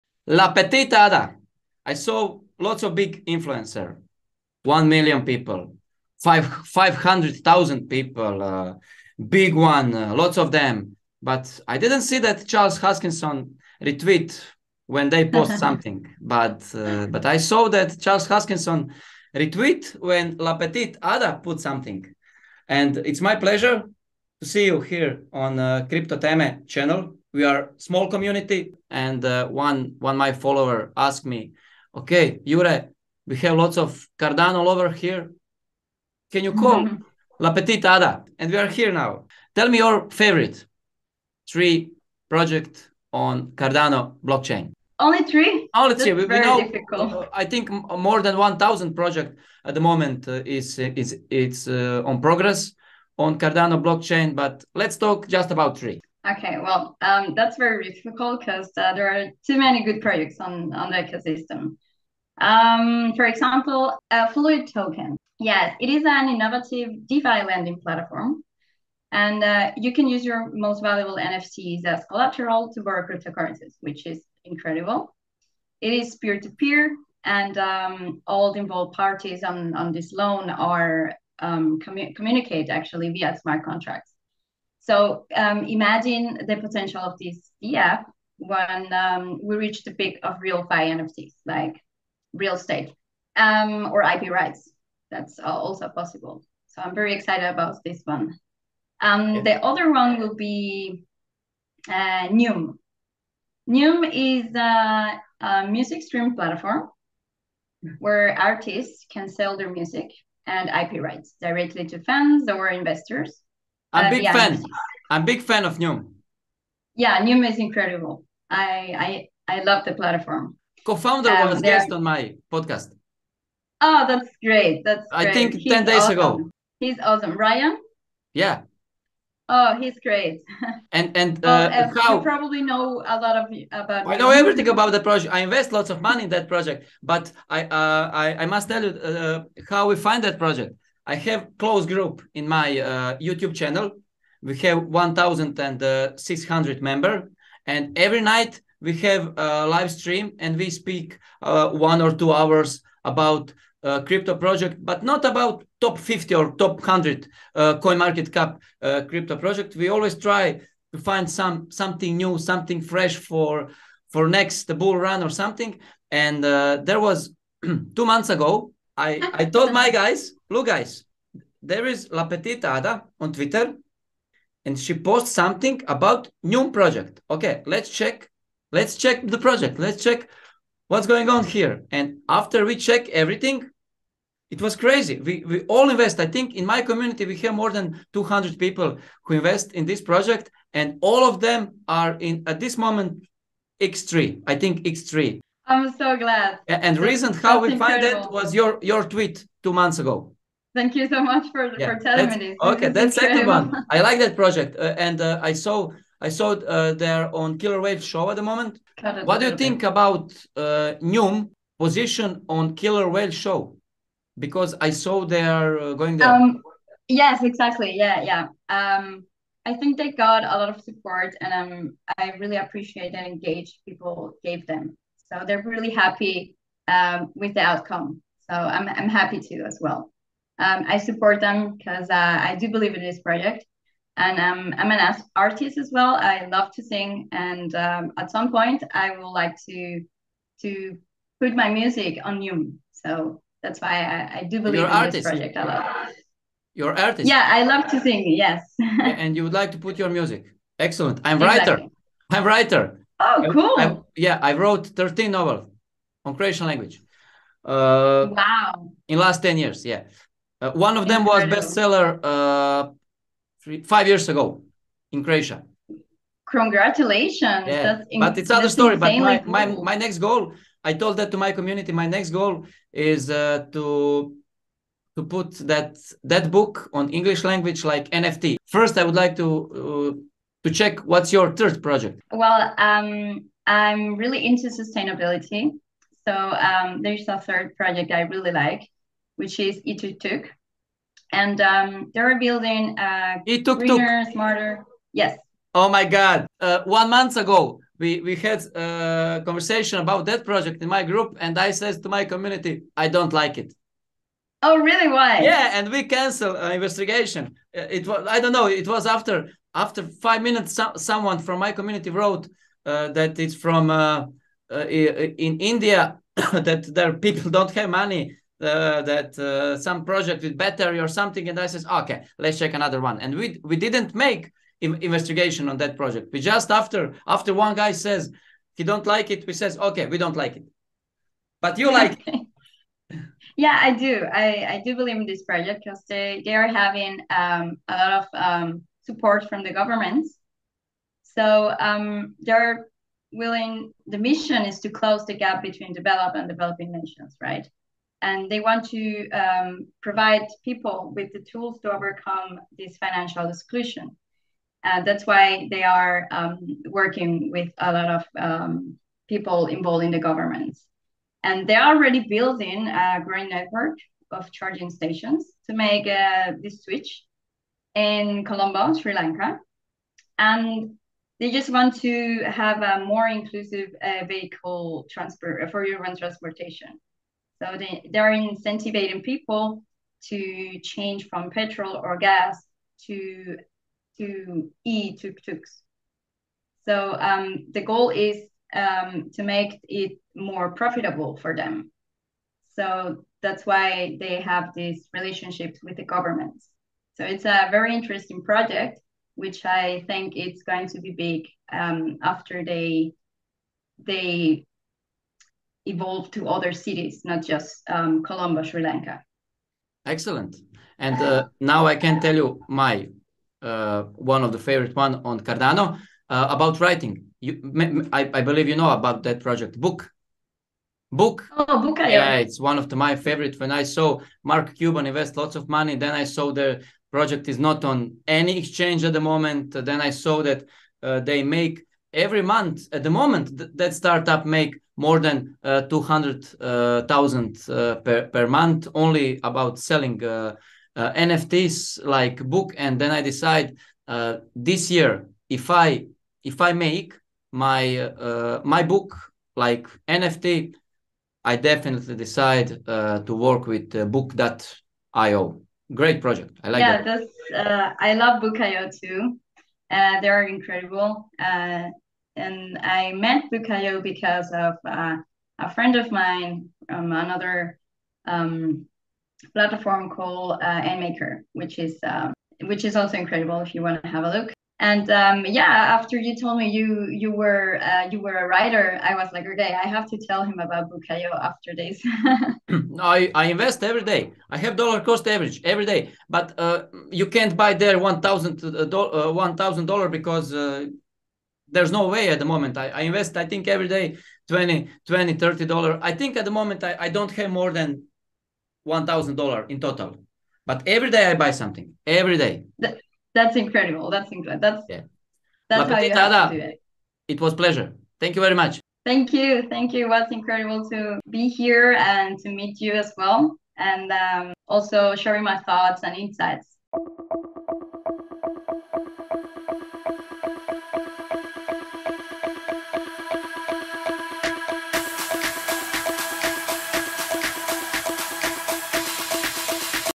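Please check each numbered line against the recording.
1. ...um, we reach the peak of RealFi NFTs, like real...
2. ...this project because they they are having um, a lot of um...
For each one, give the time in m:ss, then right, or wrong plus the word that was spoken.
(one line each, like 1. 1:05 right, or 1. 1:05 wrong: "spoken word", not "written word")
1. 1:28 right
2. 5:35 right.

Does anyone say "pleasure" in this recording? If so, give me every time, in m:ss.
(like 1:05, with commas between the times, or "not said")
0:23, 8:27.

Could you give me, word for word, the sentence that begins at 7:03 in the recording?
When I saw Mark Cuban invest lots of money, then I saw the project is not on any exchange at the moment.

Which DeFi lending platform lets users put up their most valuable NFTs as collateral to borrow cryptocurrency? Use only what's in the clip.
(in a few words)
Fluid Token.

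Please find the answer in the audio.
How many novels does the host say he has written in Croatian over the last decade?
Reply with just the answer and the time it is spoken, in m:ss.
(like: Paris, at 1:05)
13, at 4:14.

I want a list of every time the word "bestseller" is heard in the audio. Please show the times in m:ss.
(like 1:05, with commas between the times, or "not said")
4:21.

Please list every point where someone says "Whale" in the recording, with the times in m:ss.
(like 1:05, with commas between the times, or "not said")
3:27, 3:33.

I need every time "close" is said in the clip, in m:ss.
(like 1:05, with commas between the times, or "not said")
2:21, 5:44.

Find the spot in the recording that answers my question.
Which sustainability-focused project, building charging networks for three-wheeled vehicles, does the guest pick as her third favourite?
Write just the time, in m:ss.
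4:49.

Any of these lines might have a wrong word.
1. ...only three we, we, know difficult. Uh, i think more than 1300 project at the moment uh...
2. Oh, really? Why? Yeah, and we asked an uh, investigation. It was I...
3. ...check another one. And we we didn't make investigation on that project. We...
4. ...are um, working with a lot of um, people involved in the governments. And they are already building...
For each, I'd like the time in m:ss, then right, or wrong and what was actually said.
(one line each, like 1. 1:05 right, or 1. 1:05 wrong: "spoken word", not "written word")
1. 0:45 wrong: "1000", not "1300"
2. 5:04 wrong: "canceled", not "asked"
3. 5:22 right
4. 5:55 right.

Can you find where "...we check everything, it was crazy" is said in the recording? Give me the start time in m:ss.
3:02.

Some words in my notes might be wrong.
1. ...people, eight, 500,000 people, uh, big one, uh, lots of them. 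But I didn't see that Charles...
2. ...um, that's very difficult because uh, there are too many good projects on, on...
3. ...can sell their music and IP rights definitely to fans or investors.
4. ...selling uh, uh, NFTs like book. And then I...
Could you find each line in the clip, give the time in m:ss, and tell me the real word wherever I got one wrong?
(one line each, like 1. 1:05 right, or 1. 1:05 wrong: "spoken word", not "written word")
1. 0:05 wrong: "five", not "eight"
2. 0:57 right
3. 1:49 wrong: "directly", not "definitely"
4. 7:19 right.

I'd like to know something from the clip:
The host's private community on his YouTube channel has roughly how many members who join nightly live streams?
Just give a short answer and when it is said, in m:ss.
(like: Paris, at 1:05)
1,600, at 2:24.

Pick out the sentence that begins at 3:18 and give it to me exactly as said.
find it was your your tweet two months ago.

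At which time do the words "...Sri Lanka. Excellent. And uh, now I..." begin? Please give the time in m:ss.
6:48.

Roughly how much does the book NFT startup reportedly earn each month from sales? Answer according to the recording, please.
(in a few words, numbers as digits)
200,000.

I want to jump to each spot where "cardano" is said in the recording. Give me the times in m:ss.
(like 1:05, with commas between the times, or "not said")
0:34, 0:43, 0:53, 6:55.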